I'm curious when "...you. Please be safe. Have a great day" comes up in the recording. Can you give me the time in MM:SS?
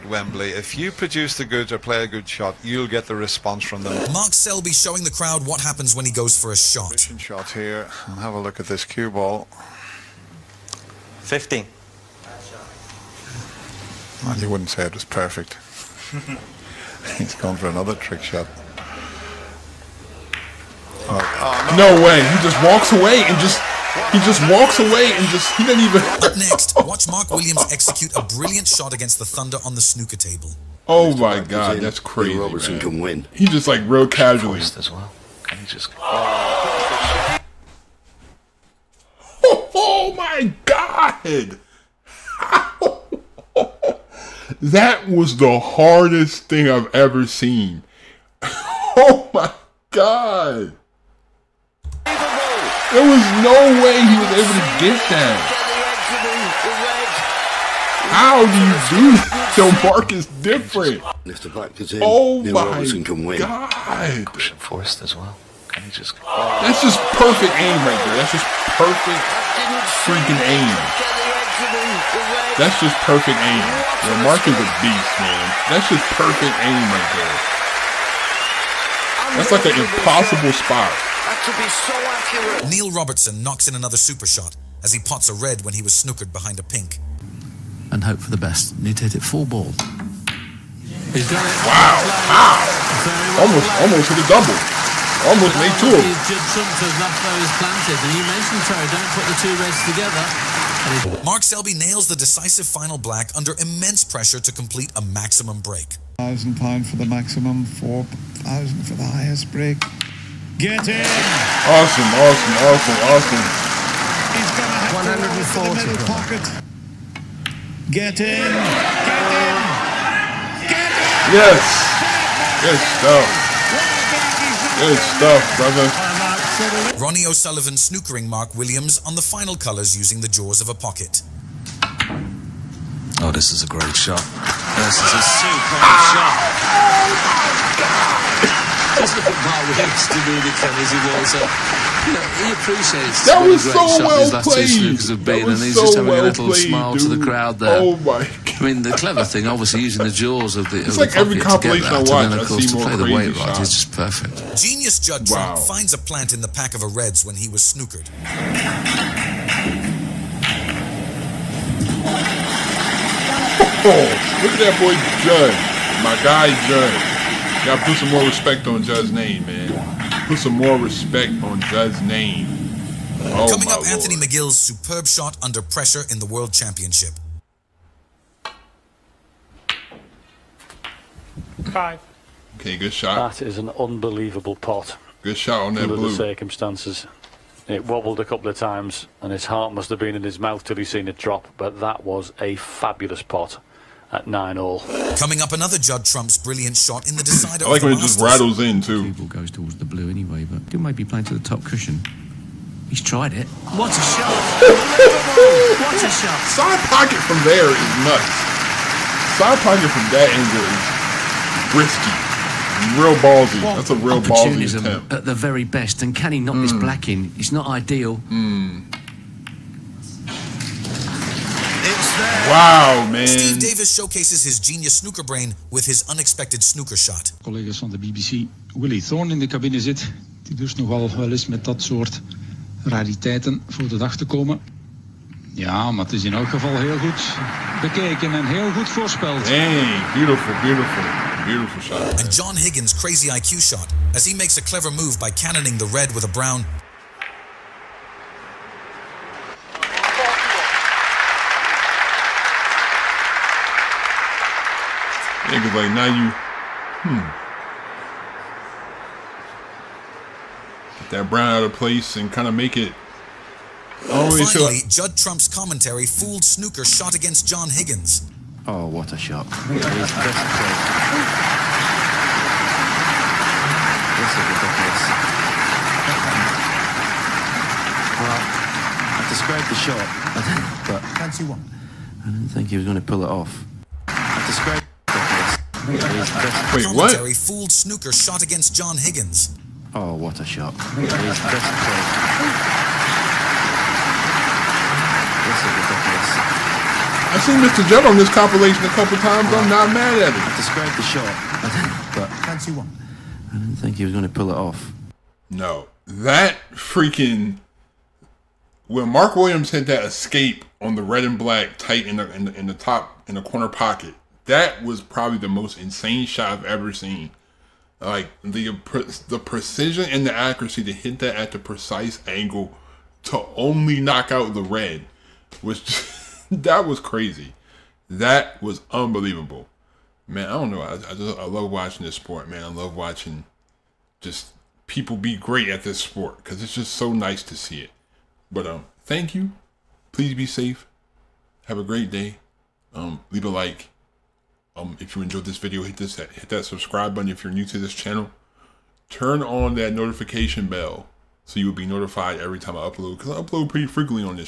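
05:39.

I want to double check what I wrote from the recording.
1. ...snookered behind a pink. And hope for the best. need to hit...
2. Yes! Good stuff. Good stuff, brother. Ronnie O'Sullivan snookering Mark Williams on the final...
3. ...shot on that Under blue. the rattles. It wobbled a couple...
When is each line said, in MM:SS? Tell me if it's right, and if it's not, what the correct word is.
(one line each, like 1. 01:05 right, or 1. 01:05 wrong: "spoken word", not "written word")
1. 01:25 right
2. 02:01 right
3. 03:05 wrong: "circumstances", not "rattles".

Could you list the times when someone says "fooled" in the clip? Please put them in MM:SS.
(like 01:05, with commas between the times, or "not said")
04:26, 04:47.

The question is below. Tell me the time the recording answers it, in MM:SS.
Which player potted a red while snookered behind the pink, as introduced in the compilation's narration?
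01:22.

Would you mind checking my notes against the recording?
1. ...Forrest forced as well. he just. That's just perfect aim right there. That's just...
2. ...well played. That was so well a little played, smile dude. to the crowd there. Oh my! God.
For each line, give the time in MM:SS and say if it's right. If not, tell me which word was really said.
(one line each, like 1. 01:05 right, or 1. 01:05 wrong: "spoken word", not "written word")
1. 01:04 right
2. 02:24 right.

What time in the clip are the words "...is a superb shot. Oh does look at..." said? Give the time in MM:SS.
02:14.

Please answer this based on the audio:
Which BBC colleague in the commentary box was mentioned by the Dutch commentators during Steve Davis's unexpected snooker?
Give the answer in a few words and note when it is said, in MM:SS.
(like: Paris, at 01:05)
Willy Thorne, at 03:48.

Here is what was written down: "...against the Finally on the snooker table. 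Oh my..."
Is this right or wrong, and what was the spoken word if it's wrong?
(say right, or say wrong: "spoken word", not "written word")
wrong: "Thunder", not "Finally".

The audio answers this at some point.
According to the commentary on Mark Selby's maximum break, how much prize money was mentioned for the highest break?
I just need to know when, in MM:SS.
01:47.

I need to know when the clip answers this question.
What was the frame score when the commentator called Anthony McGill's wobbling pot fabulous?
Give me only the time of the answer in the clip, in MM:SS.
03:14.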